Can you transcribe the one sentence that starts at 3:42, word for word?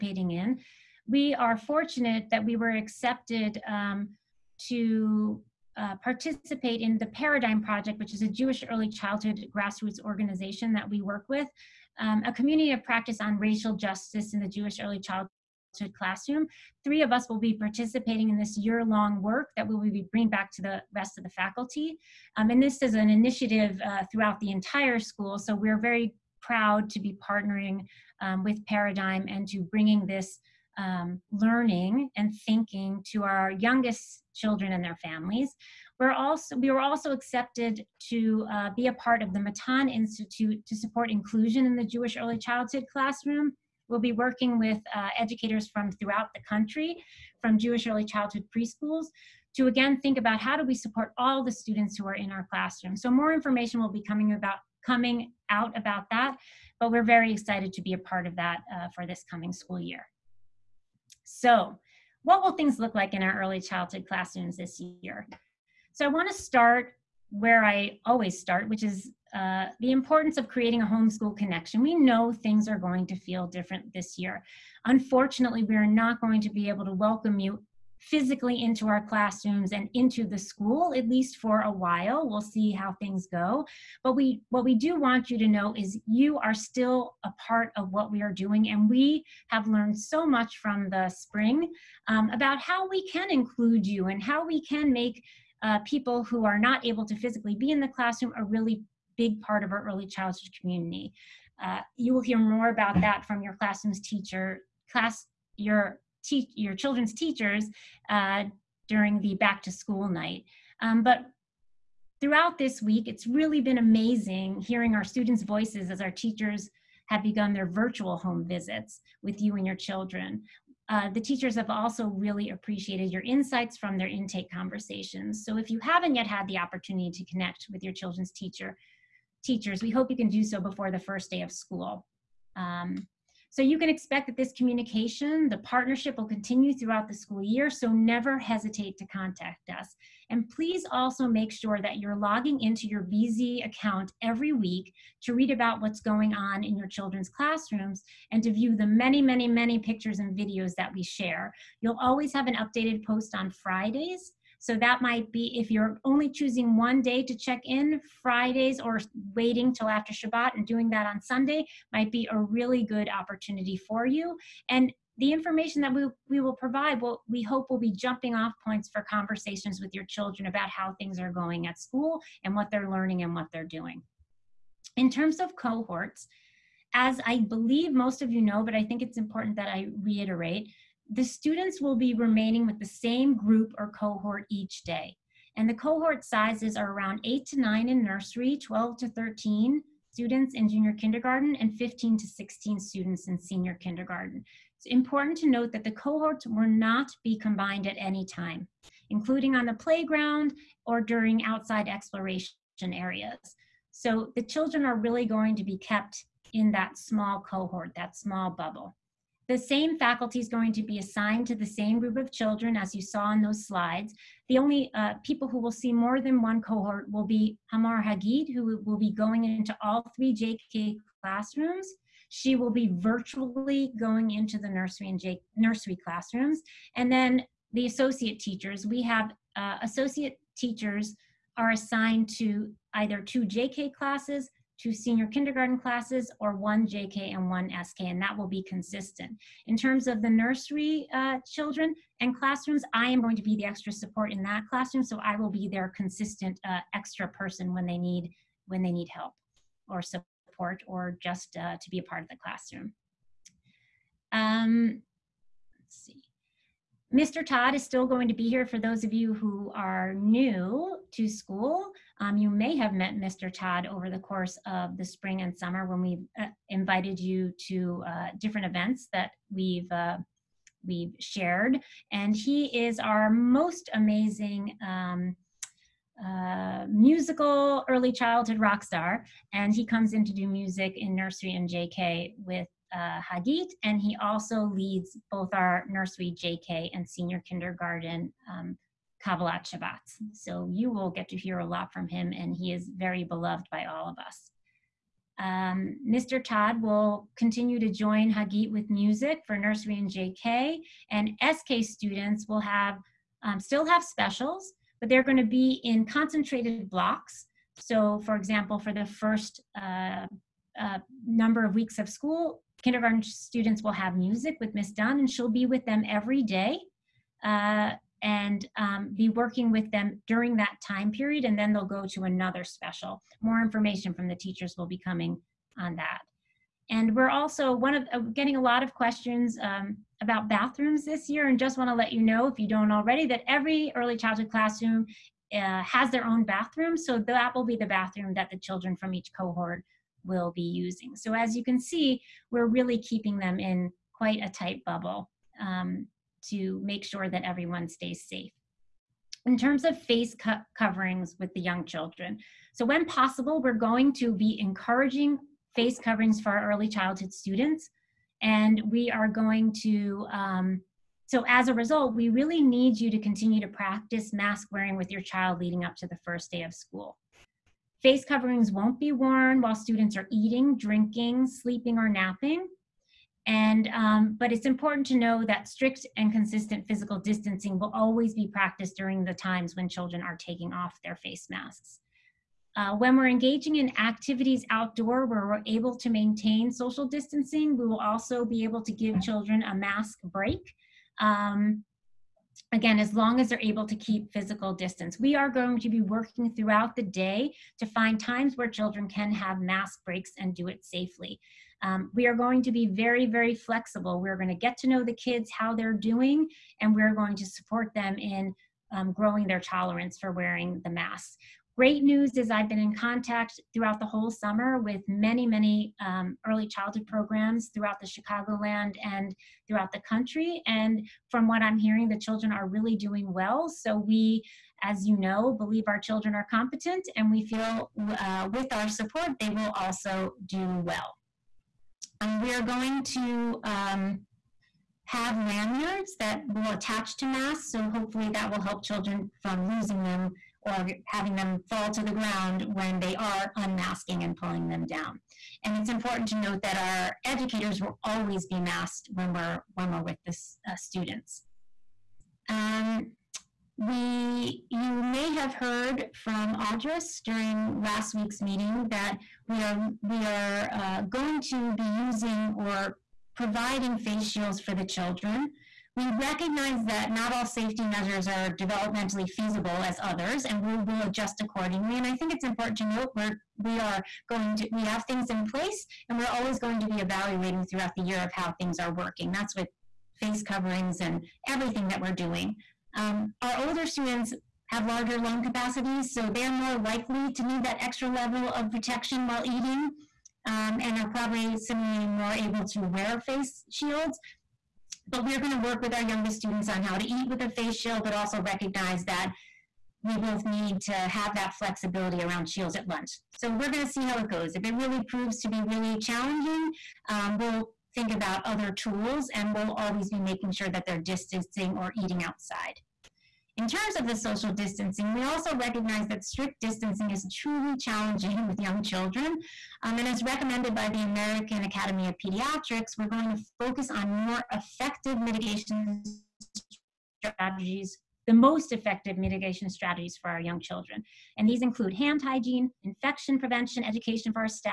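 She will be virtually going into the nursery and J nursery classrooms.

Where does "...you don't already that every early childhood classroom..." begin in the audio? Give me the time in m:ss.
5:32.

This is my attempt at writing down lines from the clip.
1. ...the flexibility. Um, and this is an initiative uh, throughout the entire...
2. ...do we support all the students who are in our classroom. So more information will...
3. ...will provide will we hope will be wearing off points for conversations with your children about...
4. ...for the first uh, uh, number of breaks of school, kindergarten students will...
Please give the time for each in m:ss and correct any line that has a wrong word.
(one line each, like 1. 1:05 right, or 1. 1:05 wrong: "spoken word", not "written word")
1. 0:21 wrong: "faculty", not "flexibility"
2. 0:50 right
3. 2:46 wrong: "jumping", not "wearing"
4. 5:08 wrong: "weeks", not "breaks".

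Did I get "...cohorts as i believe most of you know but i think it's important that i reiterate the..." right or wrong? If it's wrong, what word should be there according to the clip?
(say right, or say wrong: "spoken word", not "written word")
right.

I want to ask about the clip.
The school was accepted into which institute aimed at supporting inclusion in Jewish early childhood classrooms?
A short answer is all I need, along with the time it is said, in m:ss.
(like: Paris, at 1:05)
Matan Institute, at 0:39.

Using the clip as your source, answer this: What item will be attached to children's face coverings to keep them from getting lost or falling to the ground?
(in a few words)
Lanyards.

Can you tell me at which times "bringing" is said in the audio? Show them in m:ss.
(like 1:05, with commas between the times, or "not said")
0:20, 0:29.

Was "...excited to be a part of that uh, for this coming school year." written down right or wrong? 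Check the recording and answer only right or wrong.
right.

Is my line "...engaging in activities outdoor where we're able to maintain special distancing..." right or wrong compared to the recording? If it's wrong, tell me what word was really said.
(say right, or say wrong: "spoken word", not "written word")
wrong: "social", not "special".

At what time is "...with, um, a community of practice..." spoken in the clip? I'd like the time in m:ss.
0:11.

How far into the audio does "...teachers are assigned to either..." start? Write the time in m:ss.
3:50.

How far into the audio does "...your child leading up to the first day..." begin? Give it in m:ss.
6:05.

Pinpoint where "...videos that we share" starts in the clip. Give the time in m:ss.
2:30.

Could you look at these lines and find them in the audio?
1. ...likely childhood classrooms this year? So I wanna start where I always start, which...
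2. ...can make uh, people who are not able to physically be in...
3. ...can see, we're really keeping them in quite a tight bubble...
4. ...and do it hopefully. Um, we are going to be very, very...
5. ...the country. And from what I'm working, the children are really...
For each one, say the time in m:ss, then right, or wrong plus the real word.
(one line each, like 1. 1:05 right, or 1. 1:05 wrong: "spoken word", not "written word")
1. 1:03 wrong: "early", not "likely"
2. 1:34 right
3. 5:41 right
4. 6:40 wrong: "safely", not "hopefully"
5. 6:59 wrong: "hearing", not "working".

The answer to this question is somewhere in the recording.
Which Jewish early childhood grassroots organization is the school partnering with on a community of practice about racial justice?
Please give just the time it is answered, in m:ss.
0:07.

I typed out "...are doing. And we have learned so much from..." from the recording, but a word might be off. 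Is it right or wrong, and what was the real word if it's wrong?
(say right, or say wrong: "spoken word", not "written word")
right.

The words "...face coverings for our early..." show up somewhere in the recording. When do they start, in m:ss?
5:55.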